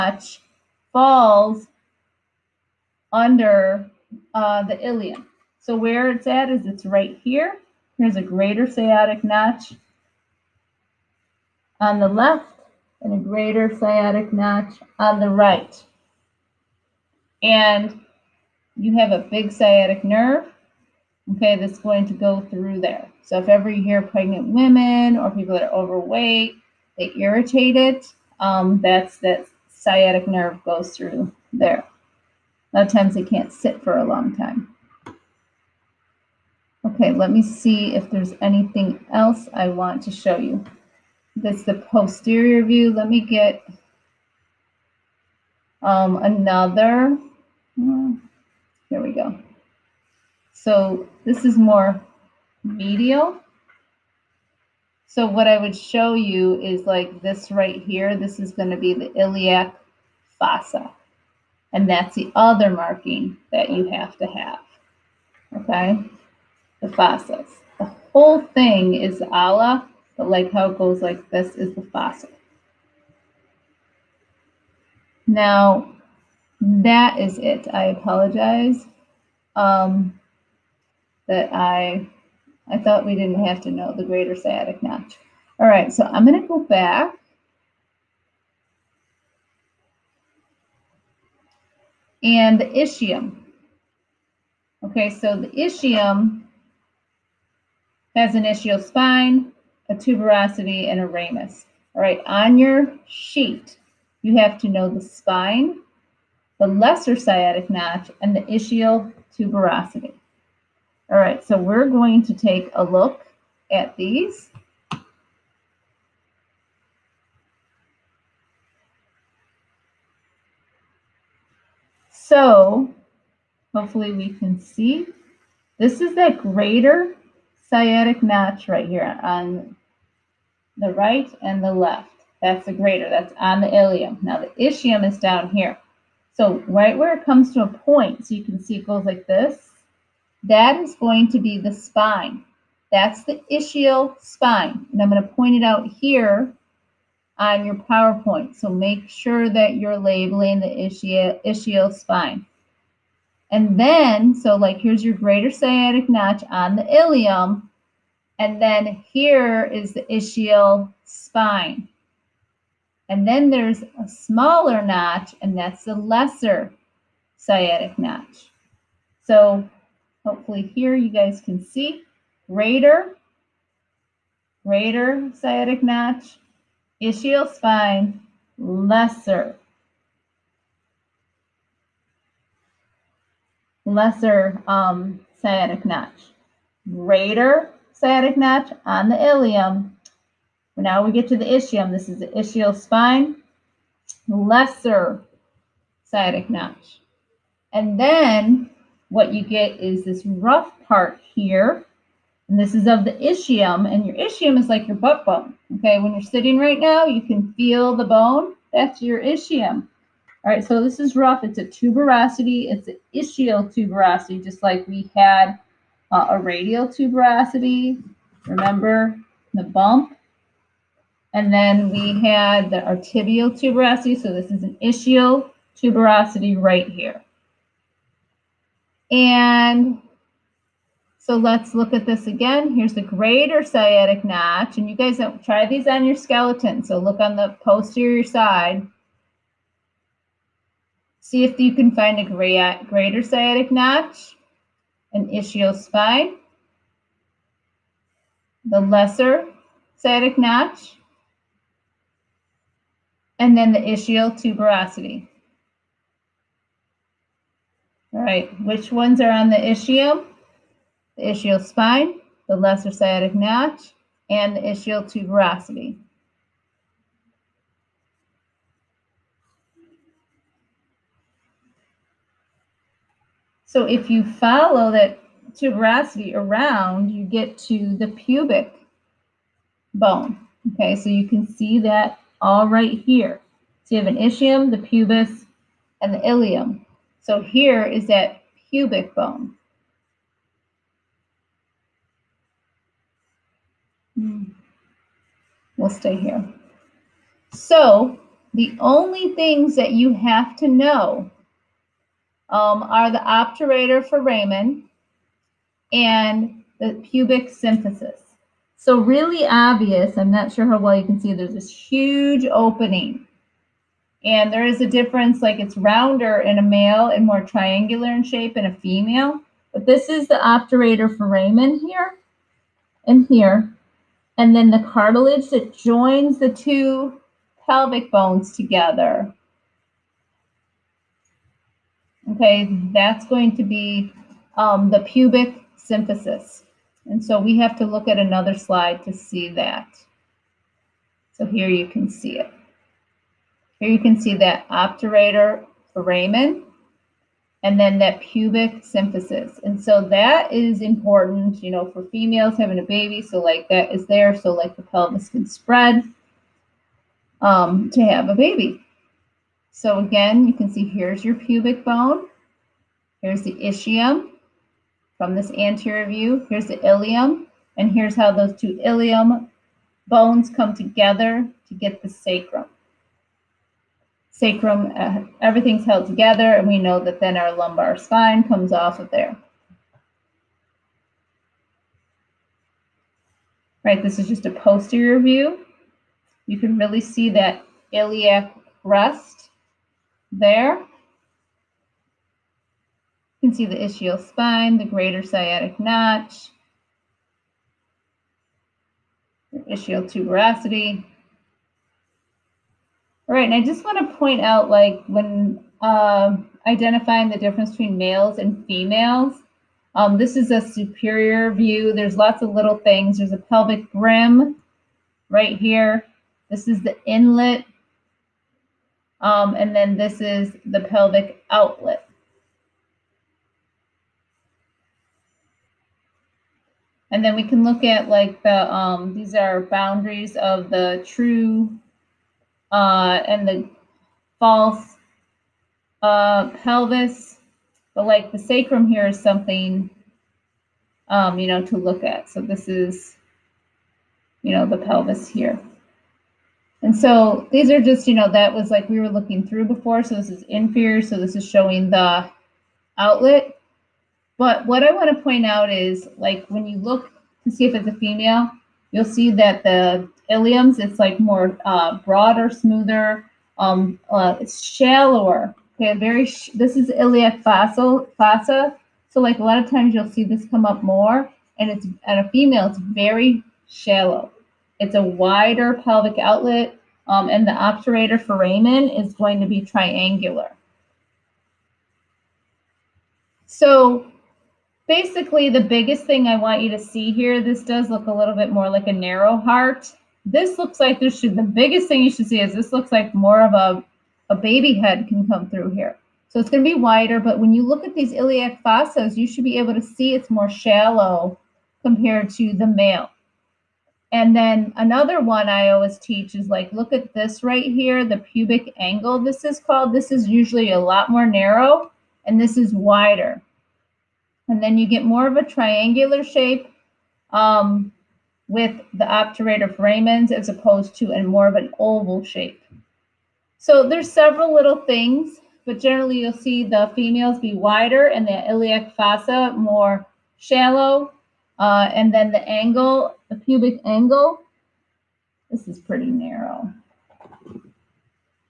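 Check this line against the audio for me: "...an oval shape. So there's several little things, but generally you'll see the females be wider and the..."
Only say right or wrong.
right.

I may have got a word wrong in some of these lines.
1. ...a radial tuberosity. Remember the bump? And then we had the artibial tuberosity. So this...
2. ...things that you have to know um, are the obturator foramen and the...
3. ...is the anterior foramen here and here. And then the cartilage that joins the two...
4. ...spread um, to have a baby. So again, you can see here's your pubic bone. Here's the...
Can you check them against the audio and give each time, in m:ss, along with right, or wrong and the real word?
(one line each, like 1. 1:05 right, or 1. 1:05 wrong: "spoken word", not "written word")
1. 3:36 right
2. 4:59 right
3. 5:20 wrong: "obturator", not "anterior"
4. 5:55 right.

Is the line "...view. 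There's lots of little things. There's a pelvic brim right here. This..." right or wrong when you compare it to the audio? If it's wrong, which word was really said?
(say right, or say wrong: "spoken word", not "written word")
right.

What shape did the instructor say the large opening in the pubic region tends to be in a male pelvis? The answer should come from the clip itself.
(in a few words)
rounder.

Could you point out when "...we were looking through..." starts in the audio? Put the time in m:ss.
7:28.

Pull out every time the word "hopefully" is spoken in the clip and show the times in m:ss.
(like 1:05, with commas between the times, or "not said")
2:03, 2:50.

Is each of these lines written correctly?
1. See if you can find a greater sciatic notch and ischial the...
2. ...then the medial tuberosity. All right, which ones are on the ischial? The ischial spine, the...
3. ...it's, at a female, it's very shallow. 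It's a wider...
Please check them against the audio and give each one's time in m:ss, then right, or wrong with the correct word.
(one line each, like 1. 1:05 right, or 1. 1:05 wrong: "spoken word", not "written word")
1. 4:01 right
2. 4:13 wrong: "ischial", not "medial"
3. 7:51 right.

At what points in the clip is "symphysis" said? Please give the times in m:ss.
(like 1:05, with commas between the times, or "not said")
5:07, 5:35, 5:48.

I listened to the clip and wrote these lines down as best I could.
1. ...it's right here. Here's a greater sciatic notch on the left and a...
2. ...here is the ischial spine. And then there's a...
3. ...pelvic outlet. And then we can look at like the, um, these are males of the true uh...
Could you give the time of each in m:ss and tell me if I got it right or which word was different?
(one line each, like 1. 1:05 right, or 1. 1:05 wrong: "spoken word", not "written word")
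1. 0:06 right
2. 2:39 right
3. 7:00 wrong: "boundaries", not "males".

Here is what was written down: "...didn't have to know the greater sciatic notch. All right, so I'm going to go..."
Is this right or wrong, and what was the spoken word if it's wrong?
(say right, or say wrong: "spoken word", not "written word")
right.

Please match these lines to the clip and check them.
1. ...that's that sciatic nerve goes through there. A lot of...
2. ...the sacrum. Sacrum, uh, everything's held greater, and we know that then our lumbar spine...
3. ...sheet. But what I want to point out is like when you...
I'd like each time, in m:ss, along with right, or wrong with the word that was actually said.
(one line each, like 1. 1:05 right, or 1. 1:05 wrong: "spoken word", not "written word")
1. 0:28 right
2. 6:12 wrong: "together", not "greater"
3. 7:32 wrong: "outlet", not "sheet".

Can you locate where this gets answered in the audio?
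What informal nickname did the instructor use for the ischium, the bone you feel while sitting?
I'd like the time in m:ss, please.
3:24.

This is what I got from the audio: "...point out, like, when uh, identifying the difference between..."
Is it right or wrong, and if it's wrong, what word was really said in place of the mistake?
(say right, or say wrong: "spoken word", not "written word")
right.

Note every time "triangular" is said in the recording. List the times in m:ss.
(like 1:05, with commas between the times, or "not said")
5:17, 7:59, 8:35.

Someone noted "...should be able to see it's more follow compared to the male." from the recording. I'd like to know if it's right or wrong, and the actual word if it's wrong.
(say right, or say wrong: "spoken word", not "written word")
wrong: "shallow", not "follow".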